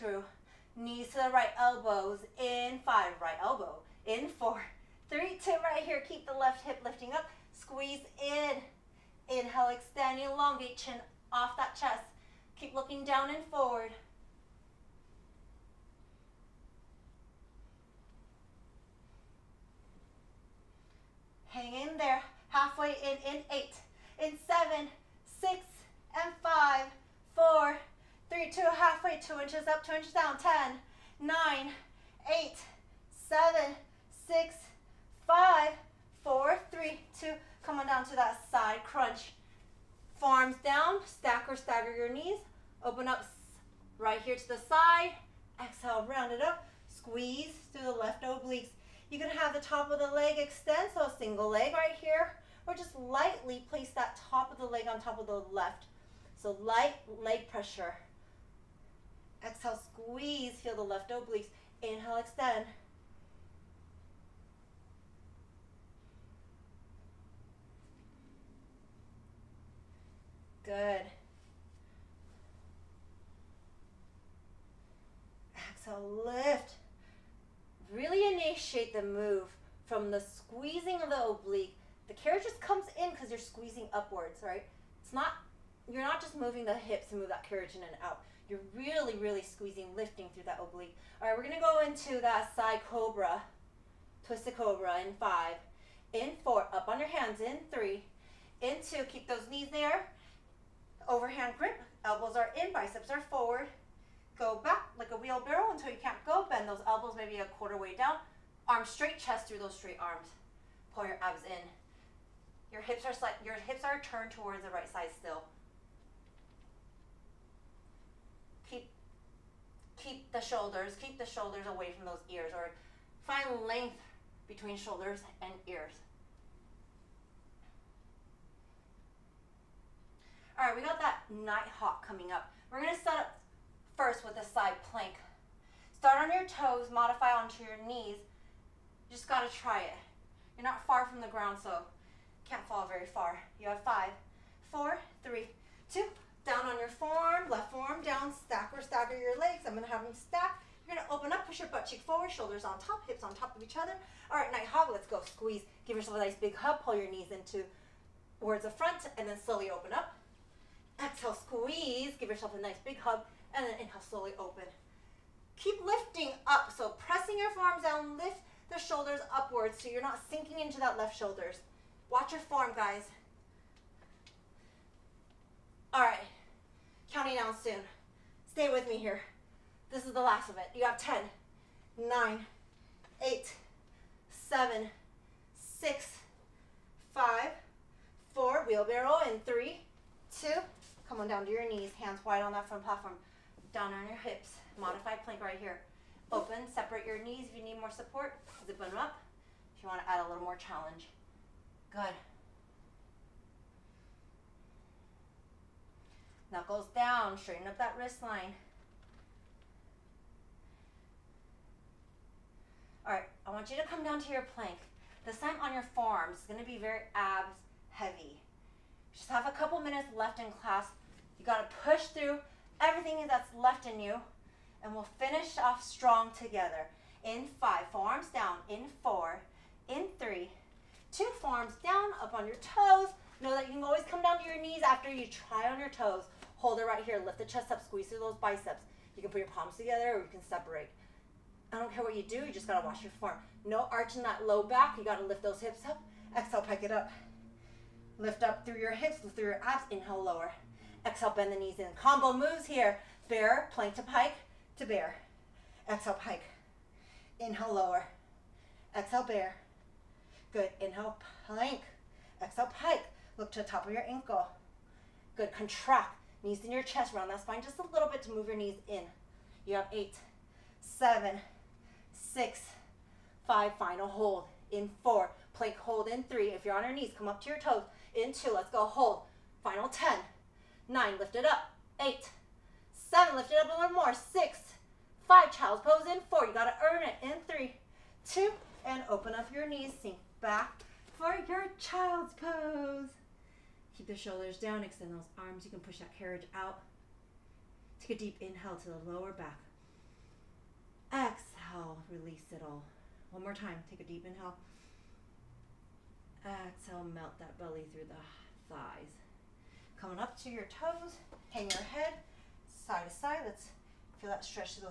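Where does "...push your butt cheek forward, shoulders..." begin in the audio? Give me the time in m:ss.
2:31.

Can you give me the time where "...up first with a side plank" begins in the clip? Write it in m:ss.
2:13.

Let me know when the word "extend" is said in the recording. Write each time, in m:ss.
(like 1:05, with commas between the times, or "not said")
0:09, 0:50, 1:02, 4:54.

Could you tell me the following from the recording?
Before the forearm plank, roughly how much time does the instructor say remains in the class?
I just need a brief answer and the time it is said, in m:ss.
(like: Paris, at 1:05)
a couple minutes, at 3:39.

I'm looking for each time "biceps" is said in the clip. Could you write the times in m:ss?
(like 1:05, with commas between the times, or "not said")
1:42, 3:58.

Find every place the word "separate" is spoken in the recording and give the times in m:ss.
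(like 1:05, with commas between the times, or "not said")
3:16, 4:00.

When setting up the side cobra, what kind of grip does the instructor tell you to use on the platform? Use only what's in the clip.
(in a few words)
Overhand grip.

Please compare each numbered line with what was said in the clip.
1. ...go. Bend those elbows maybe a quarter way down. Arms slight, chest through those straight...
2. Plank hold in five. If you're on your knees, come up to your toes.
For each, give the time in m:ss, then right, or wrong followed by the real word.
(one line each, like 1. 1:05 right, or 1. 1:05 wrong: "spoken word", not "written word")
1. 1:46 wrong: "straight", not "slight"
2. 4:35 wrong: "three", not "five".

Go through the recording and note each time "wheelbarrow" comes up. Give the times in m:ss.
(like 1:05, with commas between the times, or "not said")
1:45, 3:08.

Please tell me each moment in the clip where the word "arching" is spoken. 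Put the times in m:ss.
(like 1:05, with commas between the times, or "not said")
4:03.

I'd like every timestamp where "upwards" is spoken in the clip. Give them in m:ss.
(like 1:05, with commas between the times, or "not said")
1:23, 2:49.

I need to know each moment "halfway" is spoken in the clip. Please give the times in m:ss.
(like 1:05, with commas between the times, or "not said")
0:22, 0:28.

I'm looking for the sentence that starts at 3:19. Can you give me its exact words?
If you want to add a little more challenge.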